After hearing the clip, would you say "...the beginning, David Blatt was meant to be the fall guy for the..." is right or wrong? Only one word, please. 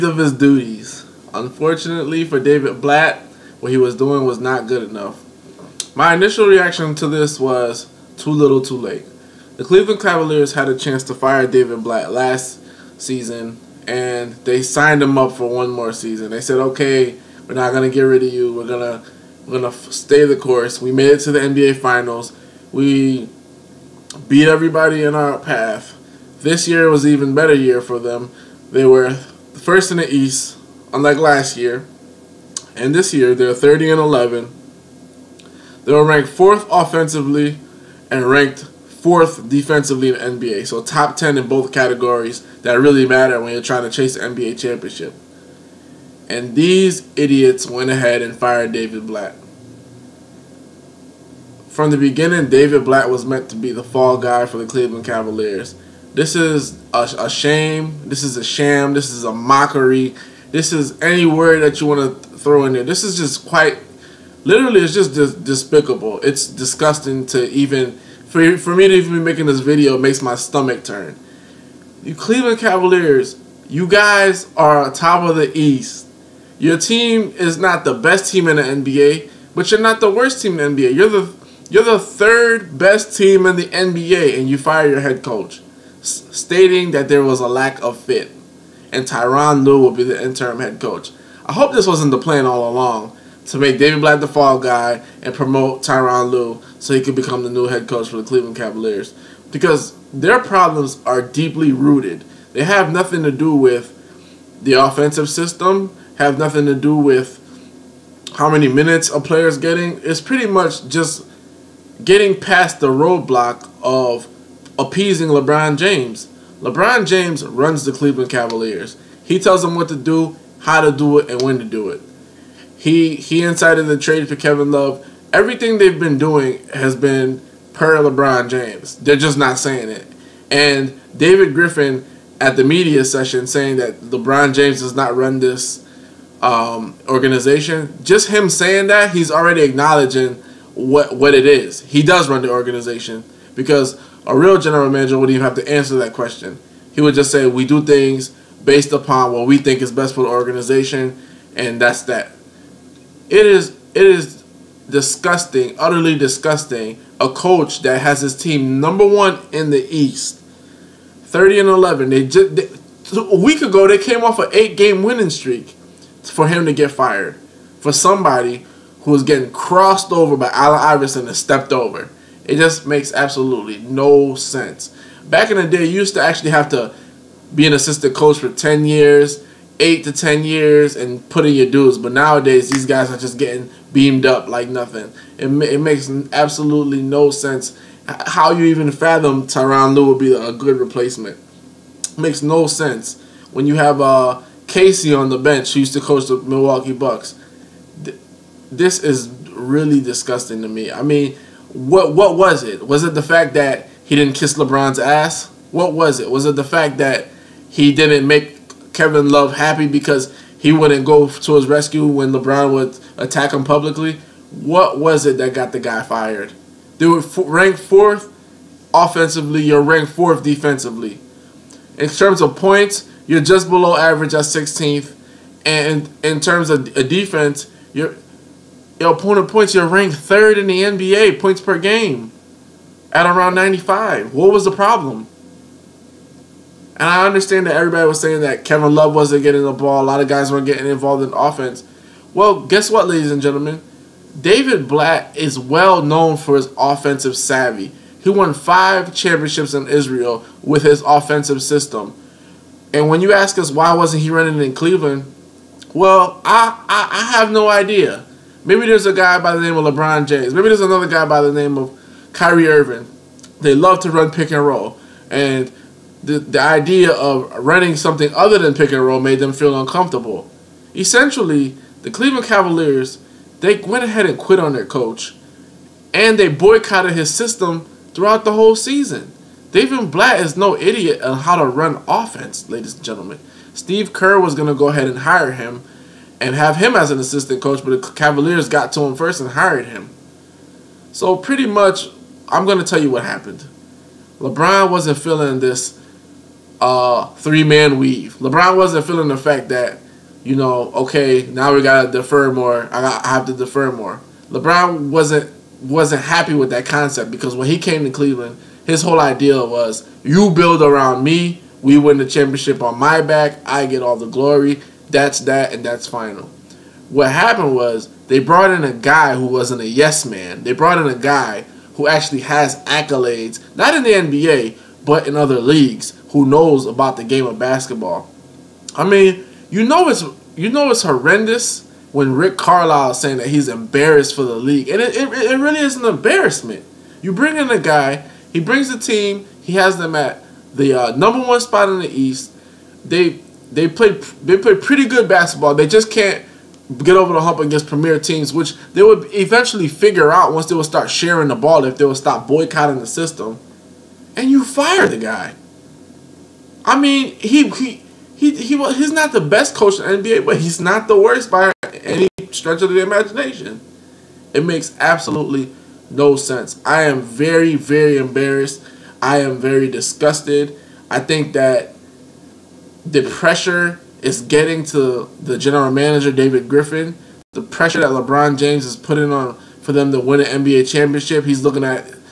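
right.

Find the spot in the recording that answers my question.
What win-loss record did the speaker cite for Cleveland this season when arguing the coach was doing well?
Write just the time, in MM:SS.
00:33.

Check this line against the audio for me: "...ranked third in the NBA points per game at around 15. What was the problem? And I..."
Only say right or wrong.
wrong.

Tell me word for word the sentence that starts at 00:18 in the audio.
We're going to we're gonna stay the course.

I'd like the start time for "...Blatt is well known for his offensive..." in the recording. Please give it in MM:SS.
04:04.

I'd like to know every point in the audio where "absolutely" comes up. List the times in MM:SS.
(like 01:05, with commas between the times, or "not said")
02:53, 03:06, 06:04.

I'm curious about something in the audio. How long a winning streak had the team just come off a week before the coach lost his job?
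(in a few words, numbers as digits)
8 games.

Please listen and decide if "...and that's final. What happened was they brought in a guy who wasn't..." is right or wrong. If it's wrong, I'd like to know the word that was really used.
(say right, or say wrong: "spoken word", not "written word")
right.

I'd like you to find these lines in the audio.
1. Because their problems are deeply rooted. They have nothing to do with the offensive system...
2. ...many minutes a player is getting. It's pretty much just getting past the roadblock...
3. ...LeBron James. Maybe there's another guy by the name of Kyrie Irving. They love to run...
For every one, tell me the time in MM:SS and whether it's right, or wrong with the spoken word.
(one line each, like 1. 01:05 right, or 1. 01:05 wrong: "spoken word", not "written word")
1. 01:39 right
2. 01:48 right
3. 04:19 right.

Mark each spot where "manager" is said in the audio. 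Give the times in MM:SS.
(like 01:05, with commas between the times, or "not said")
02:24, 06:15.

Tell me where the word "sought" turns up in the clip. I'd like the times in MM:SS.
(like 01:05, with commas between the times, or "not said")
not said.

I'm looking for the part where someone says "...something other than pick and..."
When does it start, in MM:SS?
04:27.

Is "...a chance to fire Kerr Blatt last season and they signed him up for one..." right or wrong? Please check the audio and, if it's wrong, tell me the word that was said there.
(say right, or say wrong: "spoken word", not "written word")
wrong: "David", not "Kerr".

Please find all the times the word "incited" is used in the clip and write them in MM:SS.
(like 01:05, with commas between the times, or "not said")
02:03.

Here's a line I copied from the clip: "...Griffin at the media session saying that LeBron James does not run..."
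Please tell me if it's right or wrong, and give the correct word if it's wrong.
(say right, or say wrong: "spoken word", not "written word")
right.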